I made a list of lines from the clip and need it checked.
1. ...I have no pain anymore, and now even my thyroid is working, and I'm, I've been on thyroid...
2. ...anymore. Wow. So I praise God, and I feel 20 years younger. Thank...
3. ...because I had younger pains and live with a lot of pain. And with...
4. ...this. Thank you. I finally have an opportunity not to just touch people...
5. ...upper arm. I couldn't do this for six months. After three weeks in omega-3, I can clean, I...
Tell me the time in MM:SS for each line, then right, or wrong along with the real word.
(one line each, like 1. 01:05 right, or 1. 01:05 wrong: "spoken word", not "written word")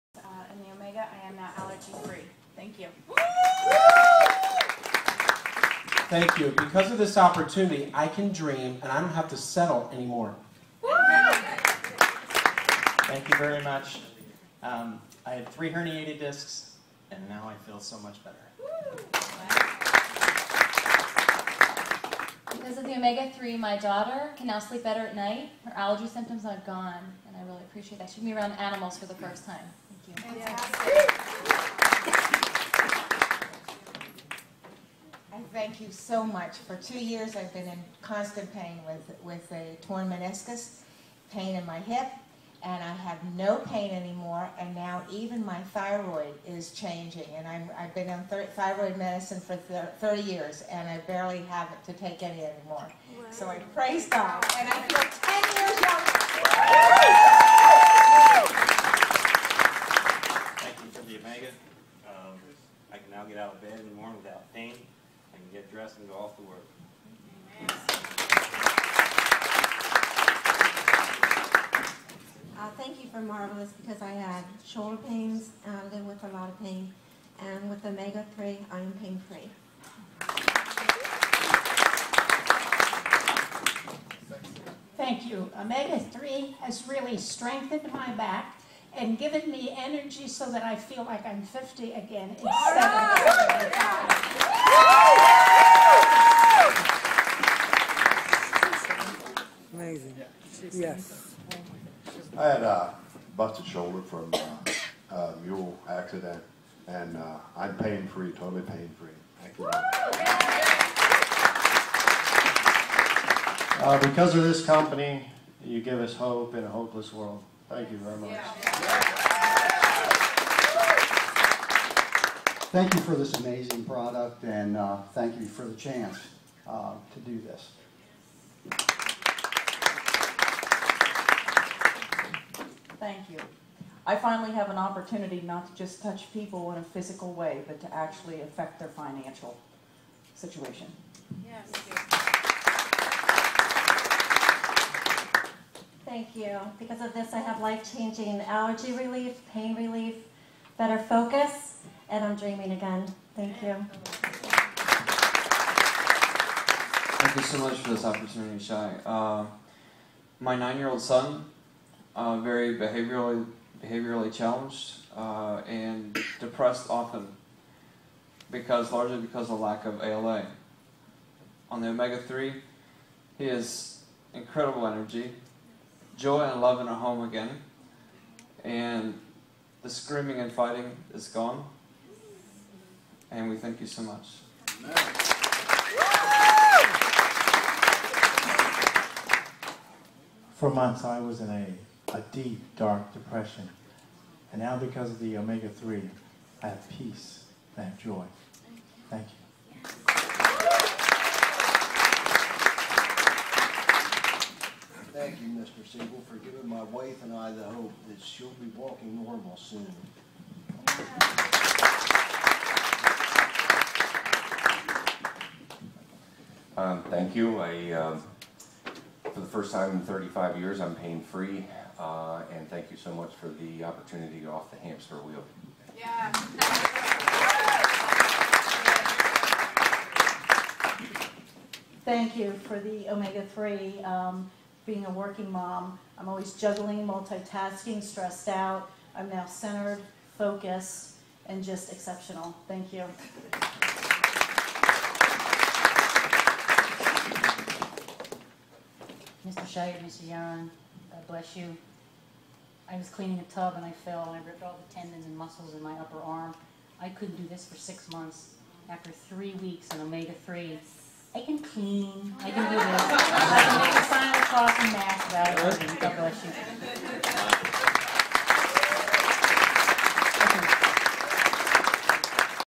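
1. 00:42 wrong: "changing", not "working"
2. 00:52 wrong: "10", not "20"
3. 01:13 wrong: "shoulder", not "younger"
4. 02:07 right
5. 04:15 right.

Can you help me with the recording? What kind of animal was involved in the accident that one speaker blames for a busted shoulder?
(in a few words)
Mule.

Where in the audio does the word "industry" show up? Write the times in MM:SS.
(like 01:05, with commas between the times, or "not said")
not said.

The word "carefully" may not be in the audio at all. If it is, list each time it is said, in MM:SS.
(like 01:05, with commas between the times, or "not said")
not said.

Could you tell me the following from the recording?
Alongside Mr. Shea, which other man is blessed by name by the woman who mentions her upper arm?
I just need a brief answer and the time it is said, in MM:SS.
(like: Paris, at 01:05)
Mr. Young, at 04:10.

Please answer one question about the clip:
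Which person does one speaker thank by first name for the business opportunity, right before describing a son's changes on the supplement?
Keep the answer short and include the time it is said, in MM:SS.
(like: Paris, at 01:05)
Shai, at 02:38.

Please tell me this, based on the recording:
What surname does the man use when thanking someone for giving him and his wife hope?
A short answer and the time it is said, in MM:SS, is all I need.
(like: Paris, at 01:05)
Siegel, at 03:25.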